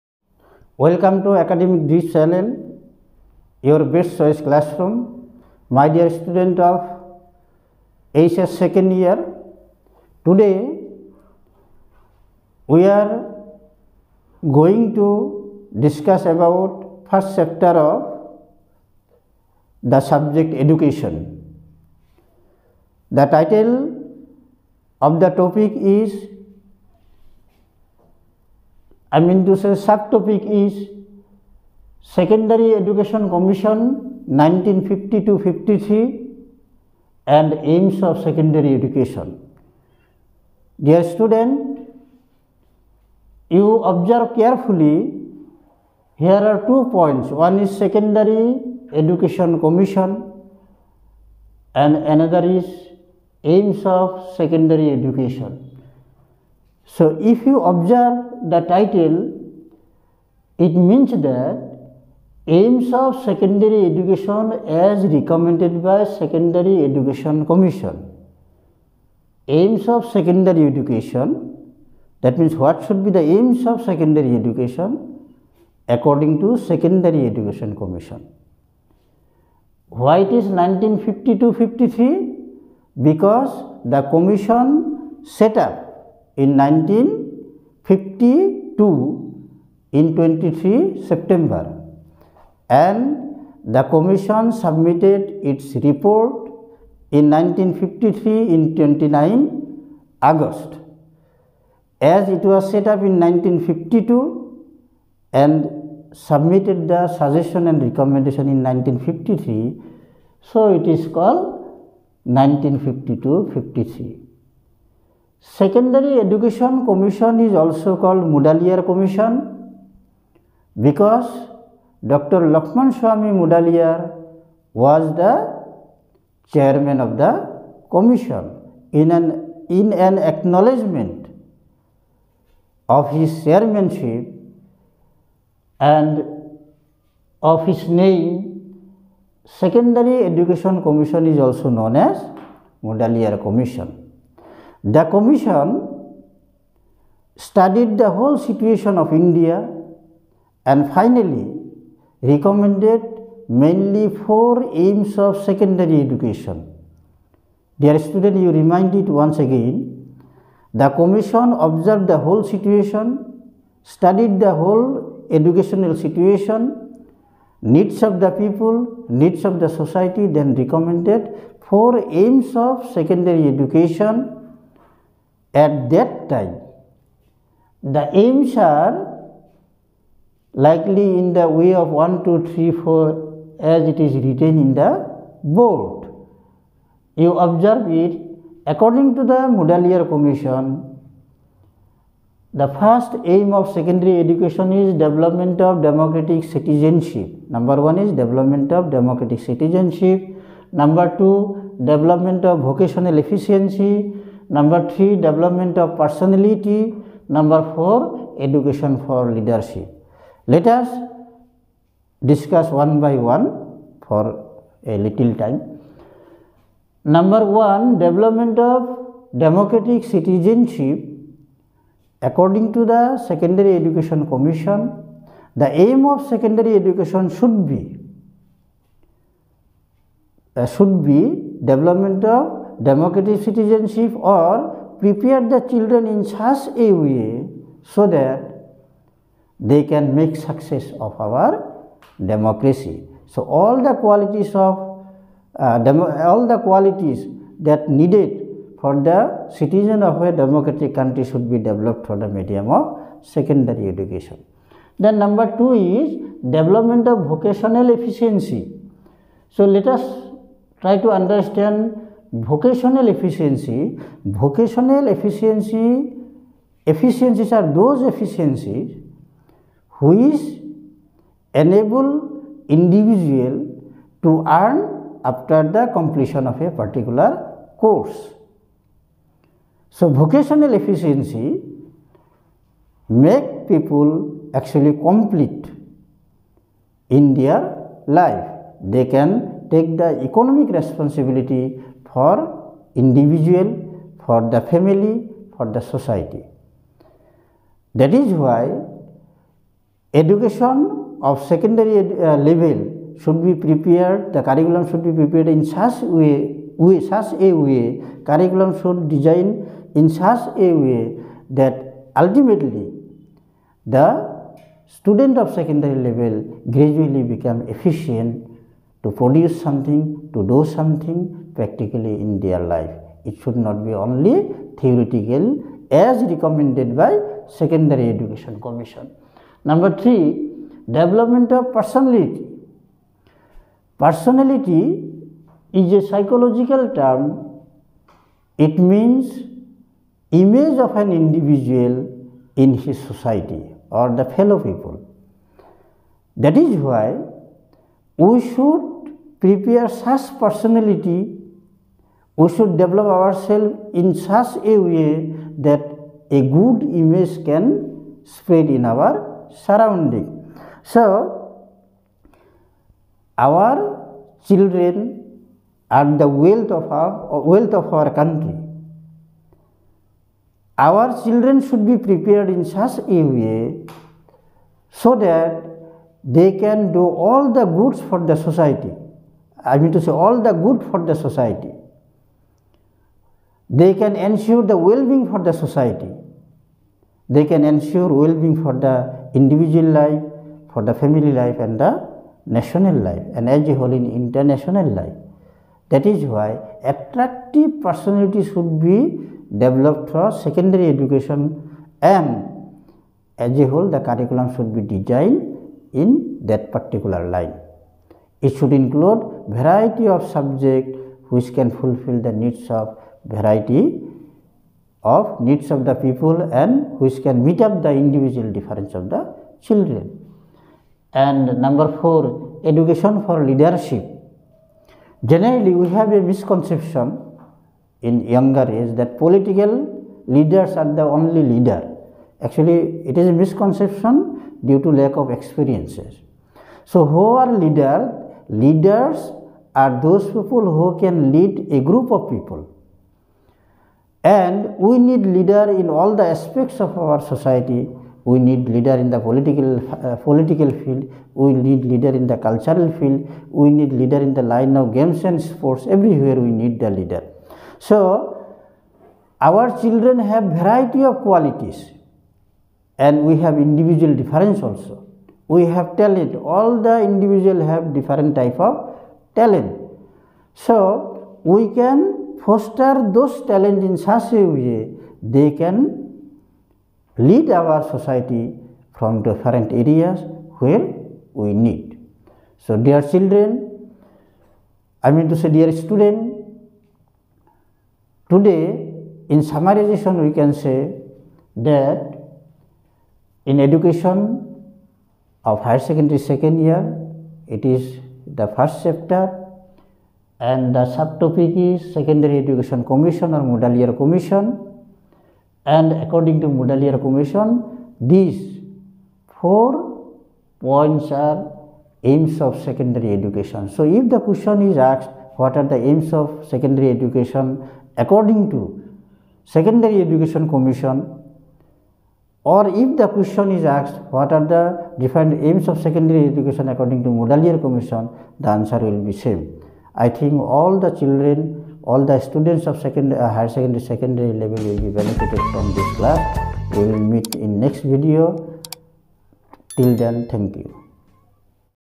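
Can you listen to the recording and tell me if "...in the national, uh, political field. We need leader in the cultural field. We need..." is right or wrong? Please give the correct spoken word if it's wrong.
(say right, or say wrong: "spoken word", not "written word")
wrong: "political", not "national".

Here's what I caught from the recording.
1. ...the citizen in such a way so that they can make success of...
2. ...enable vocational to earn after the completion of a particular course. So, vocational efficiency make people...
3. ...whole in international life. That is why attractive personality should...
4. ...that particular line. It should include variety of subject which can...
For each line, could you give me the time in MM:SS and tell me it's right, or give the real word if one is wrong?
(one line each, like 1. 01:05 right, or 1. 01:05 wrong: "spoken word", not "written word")
1. 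03:55 wrong: "children", not "citizen"
2. 04:31 wrong: "individual", not "vocational"
3. 06:33 right
4. 06:46 right.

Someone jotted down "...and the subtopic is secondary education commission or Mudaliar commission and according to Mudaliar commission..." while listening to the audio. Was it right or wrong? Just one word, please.
right.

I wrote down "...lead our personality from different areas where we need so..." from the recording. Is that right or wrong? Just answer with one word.
wrong.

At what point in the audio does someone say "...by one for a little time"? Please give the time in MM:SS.
03:32.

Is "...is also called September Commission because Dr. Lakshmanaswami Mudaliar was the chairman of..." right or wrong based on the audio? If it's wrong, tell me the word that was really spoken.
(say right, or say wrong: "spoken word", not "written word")
wrong: "Mudaliar", not "September".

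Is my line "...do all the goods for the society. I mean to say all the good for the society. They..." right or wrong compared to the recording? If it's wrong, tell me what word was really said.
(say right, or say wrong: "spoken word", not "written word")
right.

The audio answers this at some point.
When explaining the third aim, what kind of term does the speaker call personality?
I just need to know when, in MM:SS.
05:36.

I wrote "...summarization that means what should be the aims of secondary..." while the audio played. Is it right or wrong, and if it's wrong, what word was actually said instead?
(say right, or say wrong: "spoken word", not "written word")
wrong: "education", not "summarization".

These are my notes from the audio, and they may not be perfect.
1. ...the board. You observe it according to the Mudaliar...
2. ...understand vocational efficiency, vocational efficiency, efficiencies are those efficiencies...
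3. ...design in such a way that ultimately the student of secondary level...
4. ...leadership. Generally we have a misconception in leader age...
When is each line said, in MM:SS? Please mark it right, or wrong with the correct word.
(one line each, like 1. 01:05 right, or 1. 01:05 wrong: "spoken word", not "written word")
1. 03:04 right
2. 04:21 right
3. 05:09 right
4. 07:03 wrong: "younger", not "leader".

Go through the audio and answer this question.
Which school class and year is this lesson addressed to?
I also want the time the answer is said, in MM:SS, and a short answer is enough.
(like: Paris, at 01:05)
HS second year, at 00:08.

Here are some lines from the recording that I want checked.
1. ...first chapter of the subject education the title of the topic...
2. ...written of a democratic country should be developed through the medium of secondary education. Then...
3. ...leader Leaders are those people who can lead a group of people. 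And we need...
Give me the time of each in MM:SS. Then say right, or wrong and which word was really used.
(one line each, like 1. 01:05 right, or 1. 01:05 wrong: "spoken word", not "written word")
1. 00:17 right
2. 04:09 wrong: "citizen", not "written"
3. 07:17 right.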